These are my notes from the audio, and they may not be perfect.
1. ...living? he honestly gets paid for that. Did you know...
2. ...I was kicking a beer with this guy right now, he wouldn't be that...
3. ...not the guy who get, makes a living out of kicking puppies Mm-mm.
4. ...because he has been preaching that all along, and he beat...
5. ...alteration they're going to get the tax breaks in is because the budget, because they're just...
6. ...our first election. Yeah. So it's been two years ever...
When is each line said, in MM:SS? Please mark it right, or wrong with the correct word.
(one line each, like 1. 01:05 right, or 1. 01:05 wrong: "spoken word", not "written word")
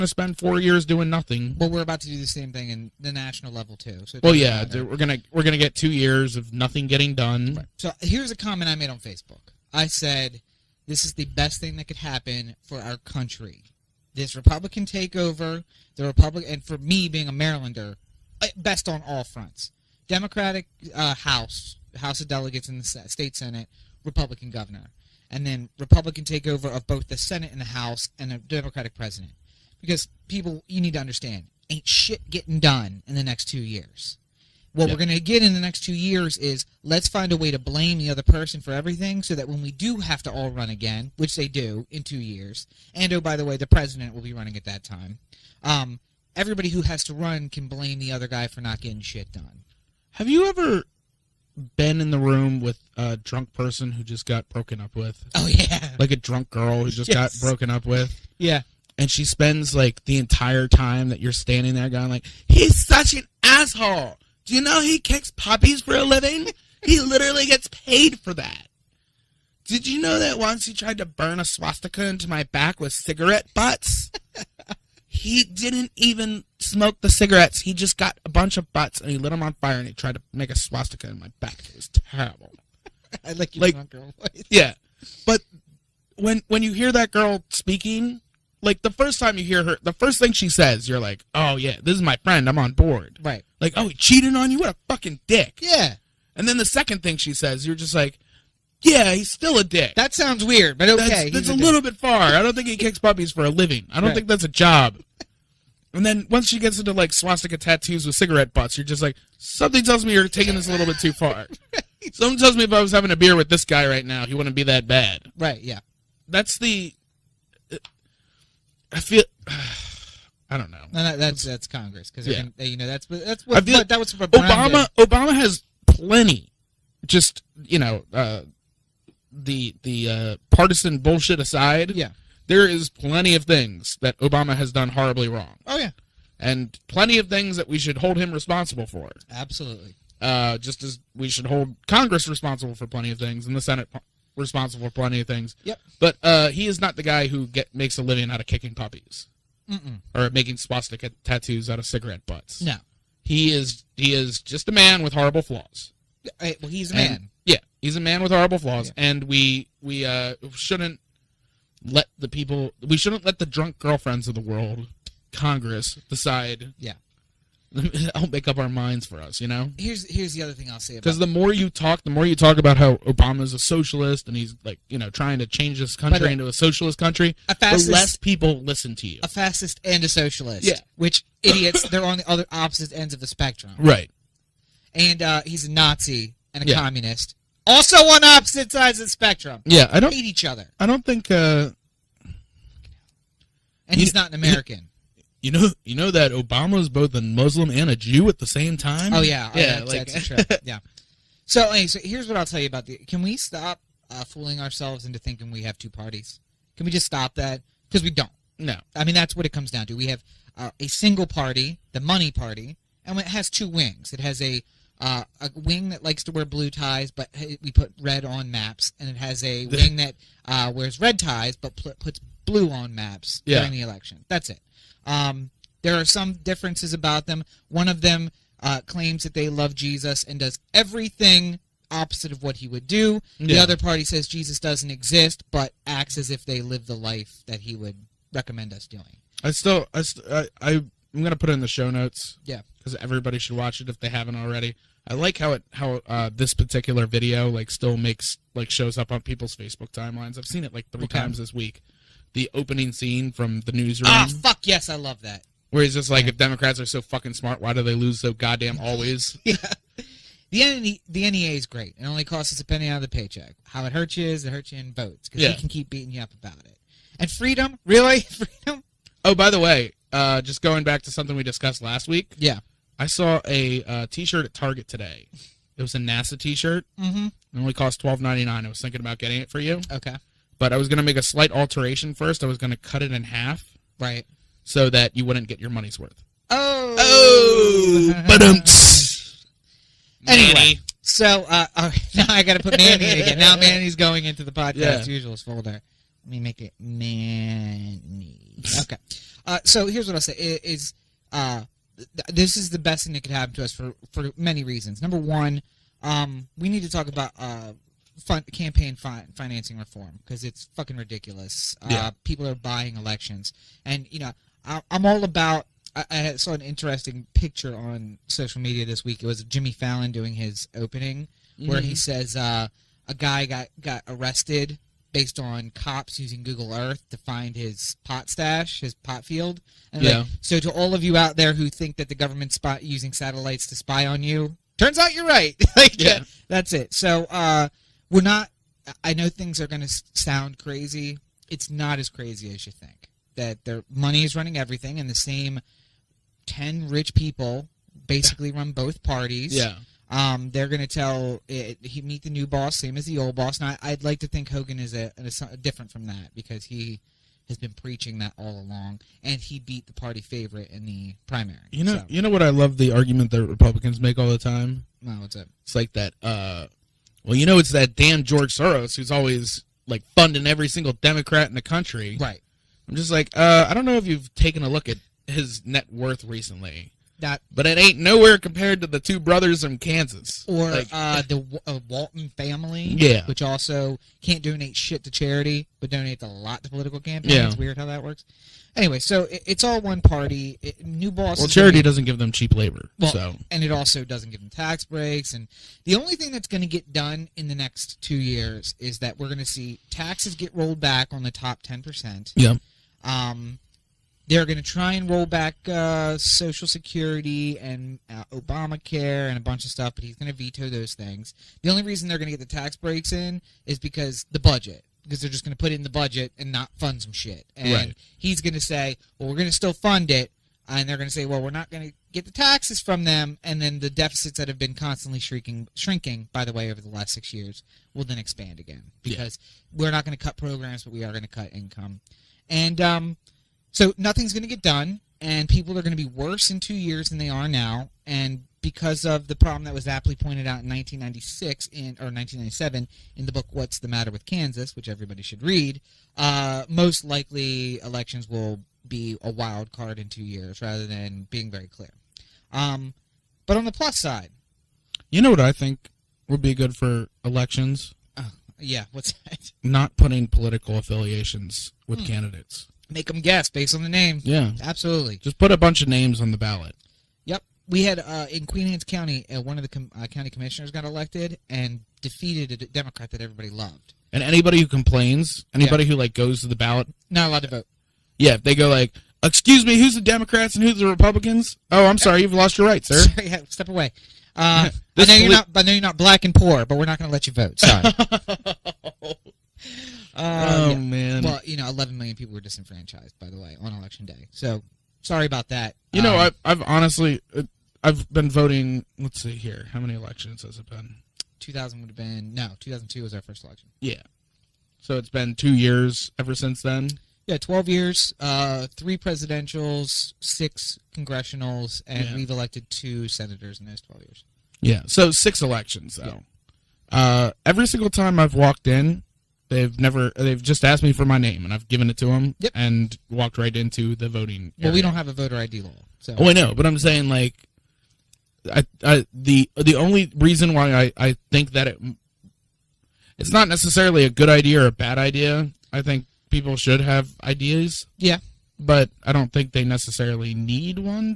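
1. 01:06 wrong: "literally", not "honestly"
2. 01:52 wrong: "having", not "kicking"
3. 02:26 right
4. 05:56 right
5. 06:51 wrong: "reason", not "alteration"
6. 08:23 right.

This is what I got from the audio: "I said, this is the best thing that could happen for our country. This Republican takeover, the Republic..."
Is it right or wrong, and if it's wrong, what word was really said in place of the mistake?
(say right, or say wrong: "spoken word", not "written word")
right.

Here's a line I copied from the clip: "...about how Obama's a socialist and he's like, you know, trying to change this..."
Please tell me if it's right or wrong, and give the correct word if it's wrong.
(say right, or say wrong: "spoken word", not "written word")
right.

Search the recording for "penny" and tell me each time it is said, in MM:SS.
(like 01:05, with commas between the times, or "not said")
04:22.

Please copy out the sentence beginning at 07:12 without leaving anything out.
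And, um, so nothing's going to get done, and people are going to be worse in two years than they are now.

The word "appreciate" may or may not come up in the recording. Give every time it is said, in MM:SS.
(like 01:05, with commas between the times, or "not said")
not said.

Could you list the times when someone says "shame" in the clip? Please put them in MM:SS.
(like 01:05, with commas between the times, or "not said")
not said.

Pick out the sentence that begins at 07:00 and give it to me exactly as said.
And they're going to say, well, we're not going to get the taxes from them.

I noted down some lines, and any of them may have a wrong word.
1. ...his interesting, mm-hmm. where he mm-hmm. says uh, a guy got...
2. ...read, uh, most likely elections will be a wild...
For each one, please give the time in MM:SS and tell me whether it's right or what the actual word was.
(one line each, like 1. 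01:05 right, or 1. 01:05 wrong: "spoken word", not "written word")
1. 05:20 wrong: "opening", not "interesting"
2. 07:25 right.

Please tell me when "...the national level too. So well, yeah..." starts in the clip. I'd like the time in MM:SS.
00:02.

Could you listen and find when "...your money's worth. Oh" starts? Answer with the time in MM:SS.
04:45.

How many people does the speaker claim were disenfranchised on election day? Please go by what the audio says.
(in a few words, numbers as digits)
11 million.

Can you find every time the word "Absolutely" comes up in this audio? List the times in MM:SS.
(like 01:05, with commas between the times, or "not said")
02:19, 07:44.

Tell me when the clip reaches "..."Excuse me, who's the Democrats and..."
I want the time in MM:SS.
07:59.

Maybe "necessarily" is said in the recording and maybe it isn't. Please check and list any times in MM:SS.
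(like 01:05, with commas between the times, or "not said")
08:53, 08:59.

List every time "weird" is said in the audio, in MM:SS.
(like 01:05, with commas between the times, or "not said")
01:40, 06:27.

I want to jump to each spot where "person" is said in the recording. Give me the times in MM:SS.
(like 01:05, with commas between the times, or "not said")
00:38, 00:53.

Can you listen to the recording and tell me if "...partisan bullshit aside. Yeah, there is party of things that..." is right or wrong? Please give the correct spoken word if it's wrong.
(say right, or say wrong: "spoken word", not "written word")
wrong: "plenty", not "party".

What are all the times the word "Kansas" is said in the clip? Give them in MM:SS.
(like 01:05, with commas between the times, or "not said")
06:19, 07:24.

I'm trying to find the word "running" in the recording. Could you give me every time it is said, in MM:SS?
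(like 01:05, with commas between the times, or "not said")
00:44, 05:44.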